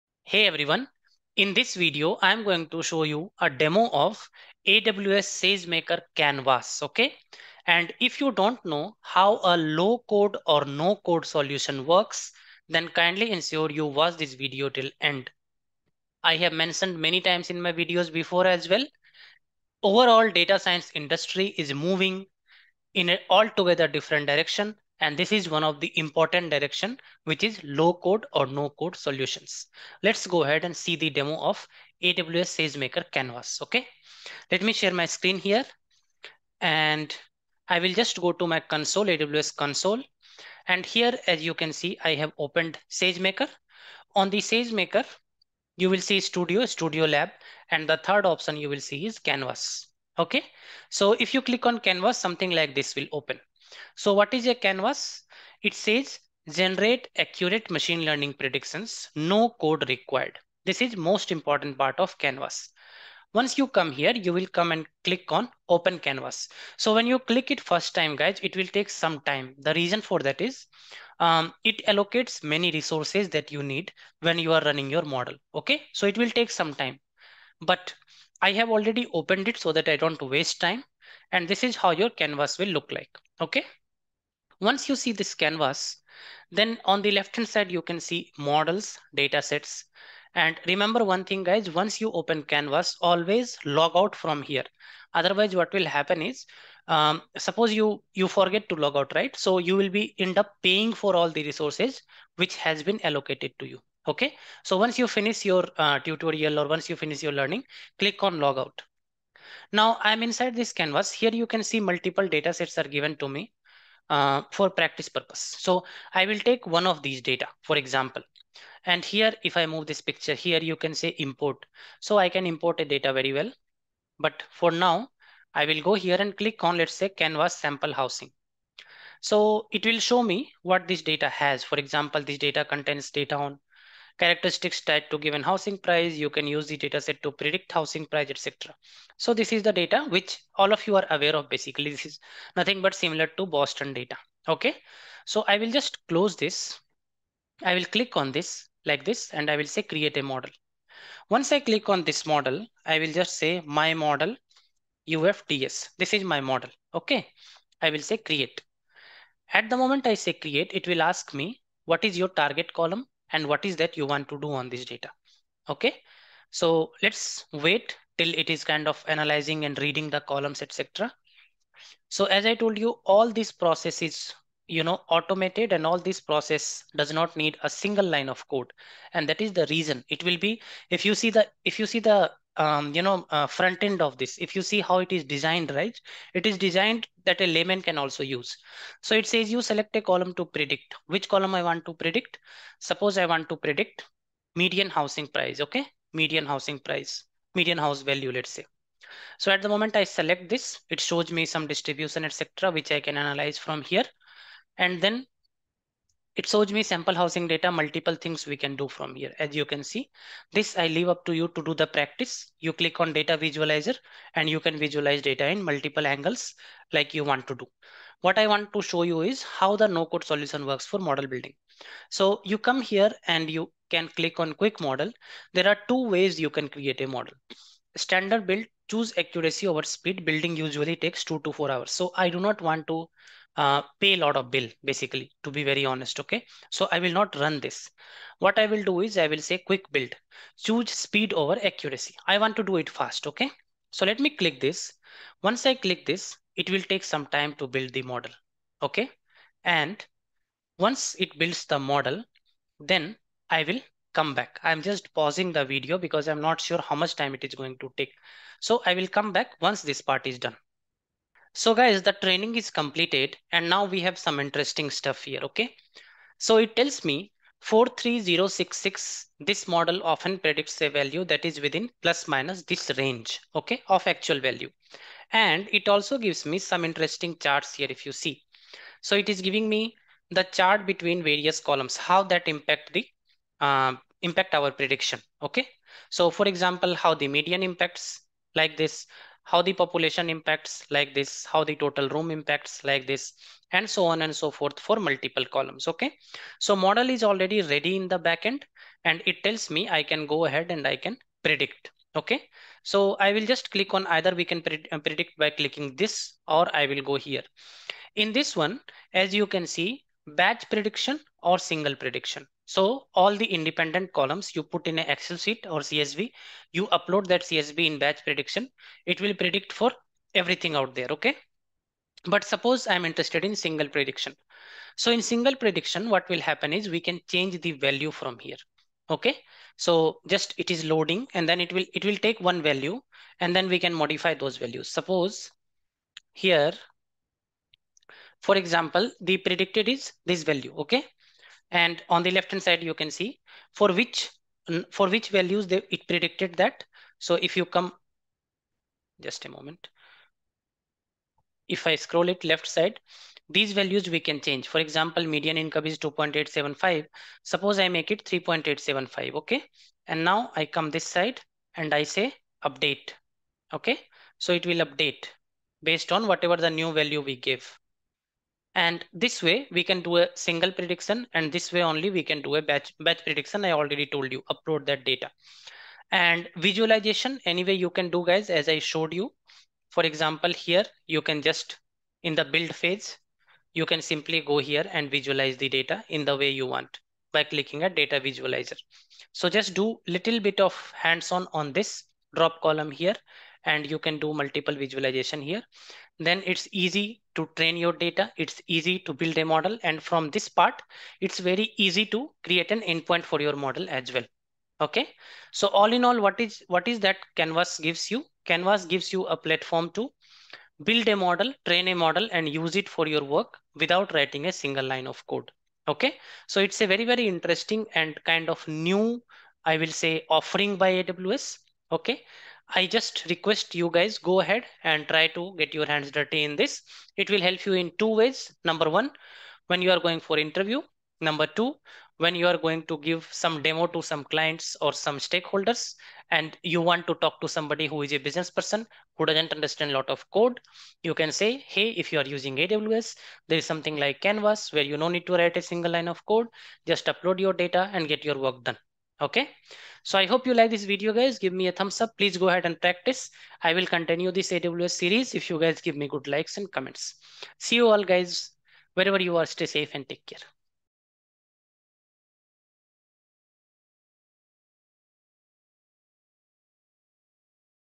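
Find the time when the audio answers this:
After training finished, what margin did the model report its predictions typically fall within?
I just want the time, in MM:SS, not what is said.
04:27.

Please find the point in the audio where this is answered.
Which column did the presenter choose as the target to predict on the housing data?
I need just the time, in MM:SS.
03:17.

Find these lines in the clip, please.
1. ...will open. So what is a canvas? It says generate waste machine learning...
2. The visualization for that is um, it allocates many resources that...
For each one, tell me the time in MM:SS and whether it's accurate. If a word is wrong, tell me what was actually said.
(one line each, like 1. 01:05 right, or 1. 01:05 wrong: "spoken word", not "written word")
1. 00:52 wrong: "accurate", not "waste"
2. 01:09 wrong: "reason", not "visualization".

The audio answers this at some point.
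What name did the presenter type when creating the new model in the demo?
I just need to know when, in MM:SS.
02:33.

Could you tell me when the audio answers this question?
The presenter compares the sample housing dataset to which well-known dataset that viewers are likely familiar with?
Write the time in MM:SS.
02:23.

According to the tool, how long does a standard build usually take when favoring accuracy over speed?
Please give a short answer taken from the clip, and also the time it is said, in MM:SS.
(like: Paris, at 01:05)
two to four hours, at 03:51.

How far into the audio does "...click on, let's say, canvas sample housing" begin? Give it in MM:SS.
02:06.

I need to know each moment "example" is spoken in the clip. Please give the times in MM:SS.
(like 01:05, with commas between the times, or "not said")
01:57, 02:11, 04:46, 05:38, 05:54, 06:20.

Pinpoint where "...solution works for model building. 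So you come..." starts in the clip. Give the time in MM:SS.
03:40.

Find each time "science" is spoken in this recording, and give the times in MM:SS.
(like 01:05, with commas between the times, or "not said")
00:20.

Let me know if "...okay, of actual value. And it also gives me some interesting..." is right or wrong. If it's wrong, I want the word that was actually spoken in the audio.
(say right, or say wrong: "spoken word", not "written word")
right.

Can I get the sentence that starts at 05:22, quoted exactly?
But suppose I'm interested in single prediction.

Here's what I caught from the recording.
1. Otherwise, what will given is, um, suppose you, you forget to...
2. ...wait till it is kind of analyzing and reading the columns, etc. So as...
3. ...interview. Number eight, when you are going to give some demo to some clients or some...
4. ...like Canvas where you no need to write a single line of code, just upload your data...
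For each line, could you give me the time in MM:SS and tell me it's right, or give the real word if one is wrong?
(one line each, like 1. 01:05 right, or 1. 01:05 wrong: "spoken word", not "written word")
1. 01:35 wrong: "happen", not "given"
2. 02:47 right
3. 07:10 wrong: "two", not "eight"
4. 07:23 right.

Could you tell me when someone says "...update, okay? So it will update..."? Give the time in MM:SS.
06:02.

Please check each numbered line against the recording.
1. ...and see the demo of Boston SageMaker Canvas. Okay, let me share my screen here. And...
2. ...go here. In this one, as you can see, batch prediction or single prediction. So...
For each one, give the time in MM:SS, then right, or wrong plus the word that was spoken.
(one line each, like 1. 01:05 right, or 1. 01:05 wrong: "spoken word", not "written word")
1. 00:30 wrong: "AWS", not "Boston"
2. 05:07 right.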